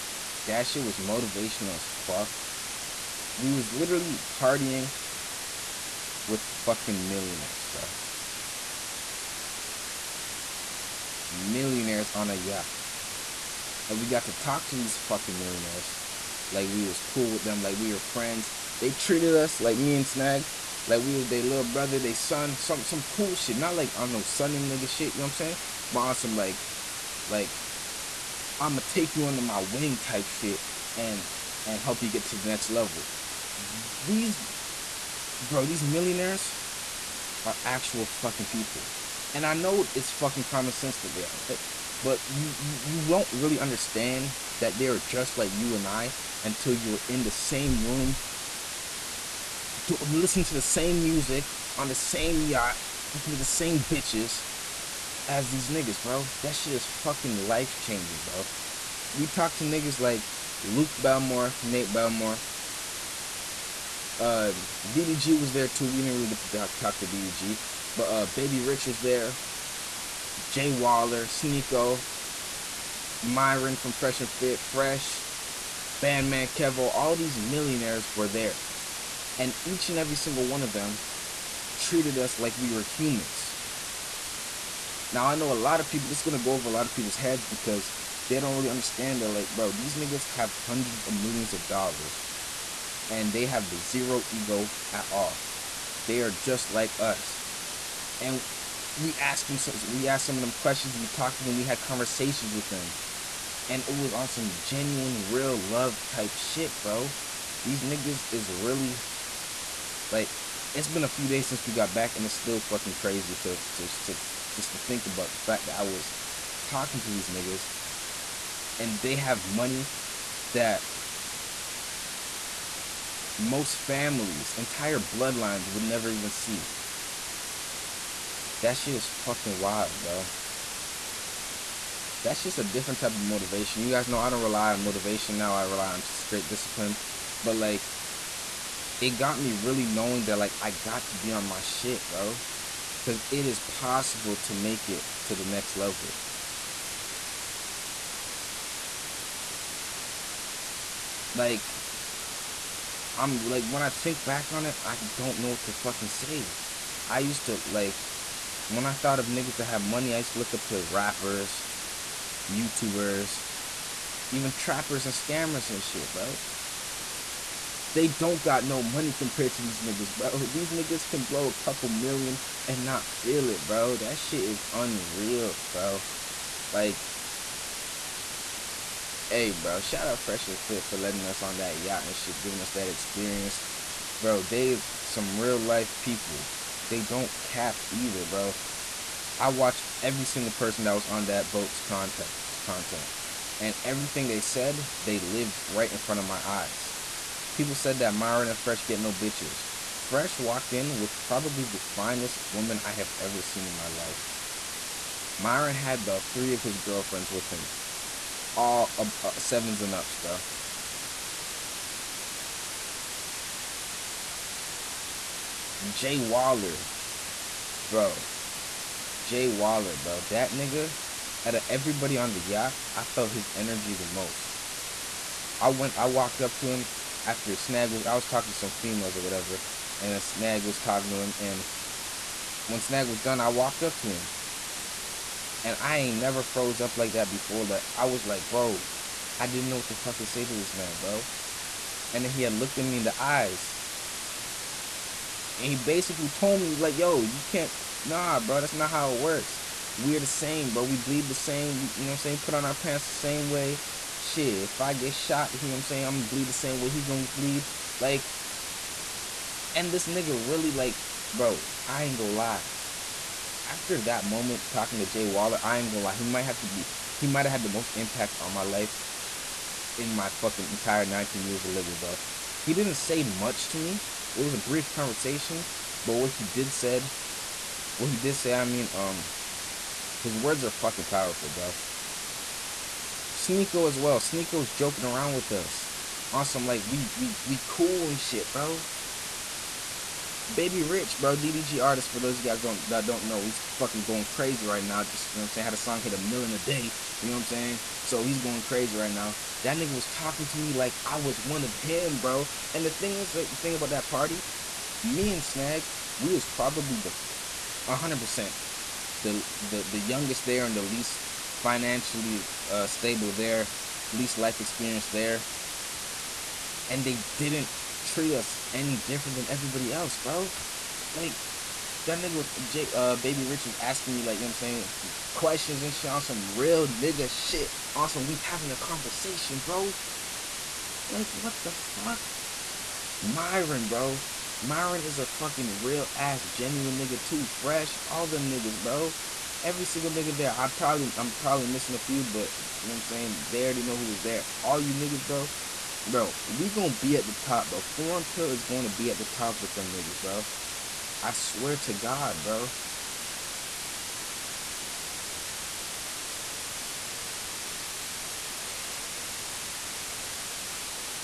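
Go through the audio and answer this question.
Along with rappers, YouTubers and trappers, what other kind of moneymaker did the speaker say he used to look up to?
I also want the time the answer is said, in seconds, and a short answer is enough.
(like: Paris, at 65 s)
Scammers, at 165 s.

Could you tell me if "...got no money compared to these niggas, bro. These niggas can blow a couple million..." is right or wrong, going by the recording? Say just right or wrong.
right.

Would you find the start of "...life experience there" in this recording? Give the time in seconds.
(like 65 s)
314 s.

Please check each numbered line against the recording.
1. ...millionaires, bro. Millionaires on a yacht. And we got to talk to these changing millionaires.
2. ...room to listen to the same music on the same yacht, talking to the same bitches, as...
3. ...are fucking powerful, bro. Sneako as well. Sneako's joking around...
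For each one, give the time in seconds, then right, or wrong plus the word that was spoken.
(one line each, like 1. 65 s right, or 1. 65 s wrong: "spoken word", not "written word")
1. 7 s wrong: "fucking", not "changing"
2. 47 s right
3. 280 s right.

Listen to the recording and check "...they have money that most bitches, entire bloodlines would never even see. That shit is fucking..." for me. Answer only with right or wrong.
wrong.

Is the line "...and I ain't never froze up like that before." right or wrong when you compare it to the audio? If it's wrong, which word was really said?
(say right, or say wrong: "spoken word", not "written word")
right.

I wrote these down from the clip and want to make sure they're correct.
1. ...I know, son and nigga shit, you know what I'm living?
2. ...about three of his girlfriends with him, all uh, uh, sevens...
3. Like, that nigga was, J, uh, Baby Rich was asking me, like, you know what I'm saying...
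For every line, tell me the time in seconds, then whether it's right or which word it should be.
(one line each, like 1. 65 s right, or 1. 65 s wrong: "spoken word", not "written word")
1. 23 s wrong: "saying", not "living"
2. 206 s right
3. 321 s right.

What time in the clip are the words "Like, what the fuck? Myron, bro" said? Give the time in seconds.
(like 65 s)
331 s.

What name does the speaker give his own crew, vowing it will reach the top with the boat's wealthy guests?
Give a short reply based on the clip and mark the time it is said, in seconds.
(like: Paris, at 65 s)
Foreign Pill, at 347 s.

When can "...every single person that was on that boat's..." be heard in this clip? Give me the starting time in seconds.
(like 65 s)
190 s.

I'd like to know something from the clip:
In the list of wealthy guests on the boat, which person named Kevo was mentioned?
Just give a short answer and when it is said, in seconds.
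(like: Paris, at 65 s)
Bandman Kevo, at 76 s.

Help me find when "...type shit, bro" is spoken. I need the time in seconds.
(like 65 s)
106 s.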